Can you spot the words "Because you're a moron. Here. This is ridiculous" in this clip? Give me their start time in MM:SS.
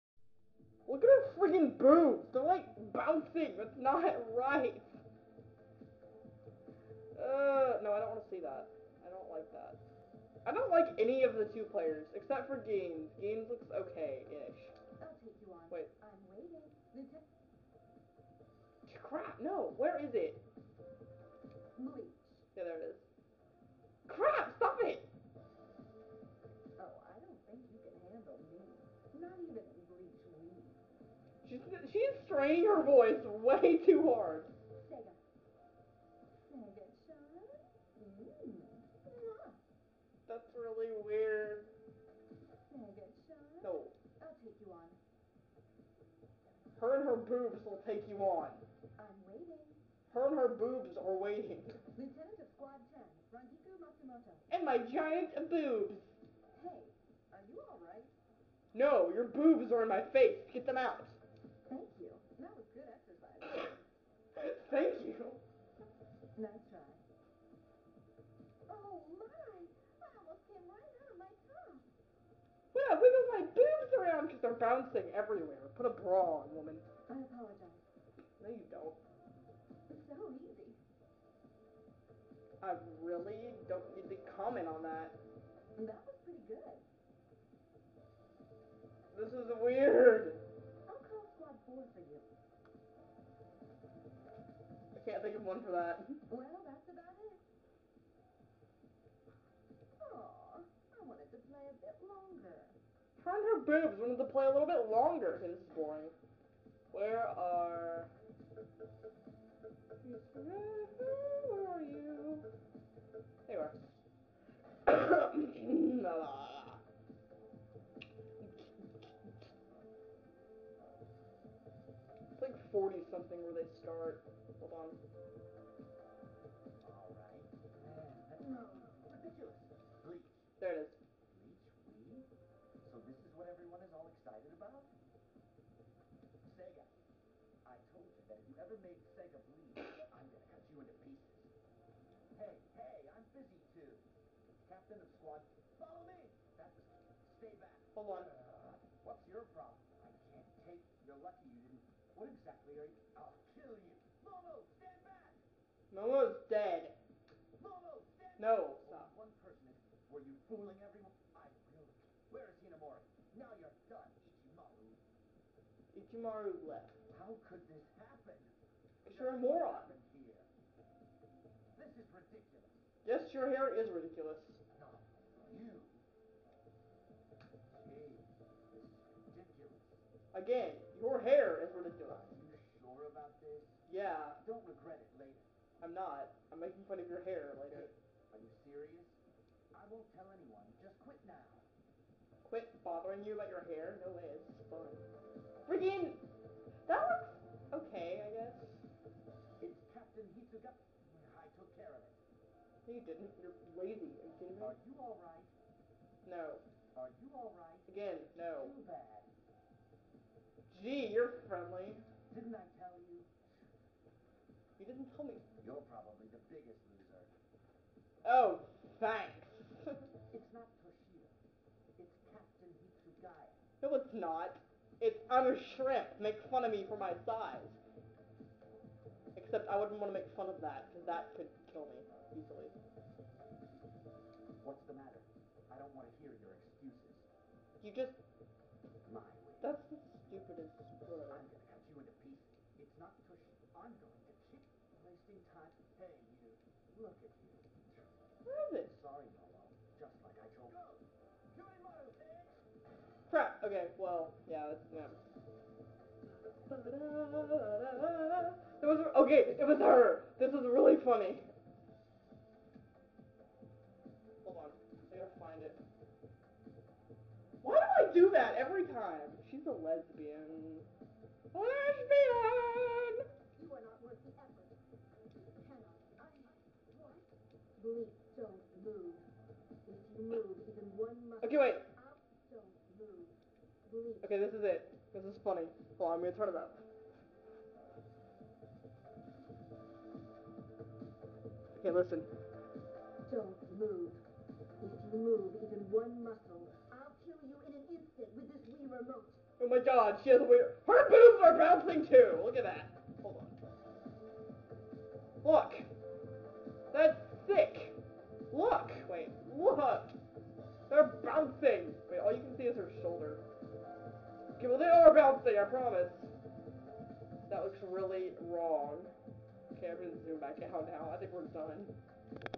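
02:49.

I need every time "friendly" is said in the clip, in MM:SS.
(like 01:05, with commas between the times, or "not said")
03:31.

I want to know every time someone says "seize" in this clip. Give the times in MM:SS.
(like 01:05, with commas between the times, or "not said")
not said.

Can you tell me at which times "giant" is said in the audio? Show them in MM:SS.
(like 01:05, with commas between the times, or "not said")
00:54.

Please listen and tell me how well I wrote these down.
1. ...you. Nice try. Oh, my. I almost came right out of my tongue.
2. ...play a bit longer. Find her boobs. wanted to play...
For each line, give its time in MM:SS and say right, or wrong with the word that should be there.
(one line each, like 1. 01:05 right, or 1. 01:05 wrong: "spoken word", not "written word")
1. 01:05 right
2. 01:41 right.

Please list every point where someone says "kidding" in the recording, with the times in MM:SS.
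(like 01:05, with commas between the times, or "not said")
03:24.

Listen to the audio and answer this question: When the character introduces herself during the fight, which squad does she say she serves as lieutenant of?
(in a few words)
Squad 10.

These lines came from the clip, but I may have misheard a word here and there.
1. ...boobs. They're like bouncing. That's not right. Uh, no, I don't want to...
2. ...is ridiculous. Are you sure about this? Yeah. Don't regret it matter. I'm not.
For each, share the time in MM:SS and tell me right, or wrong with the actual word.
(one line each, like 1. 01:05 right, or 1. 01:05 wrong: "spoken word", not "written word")
1. 00:01 right
2. 03:01 wrong: "later", not "matter".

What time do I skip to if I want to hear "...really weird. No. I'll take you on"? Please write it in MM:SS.
00:40.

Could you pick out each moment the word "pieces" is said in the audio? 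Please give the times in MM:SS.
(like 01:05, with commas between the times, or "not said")
02:21, 04:02.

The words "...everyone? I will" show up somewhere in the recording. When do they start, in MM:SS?
02:40.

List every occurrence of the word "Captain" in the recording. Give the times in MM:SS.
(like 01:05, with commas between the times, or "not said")
02:24, 03:19.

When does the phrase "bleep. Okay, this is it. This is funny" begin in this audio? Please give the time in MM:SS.
04:43.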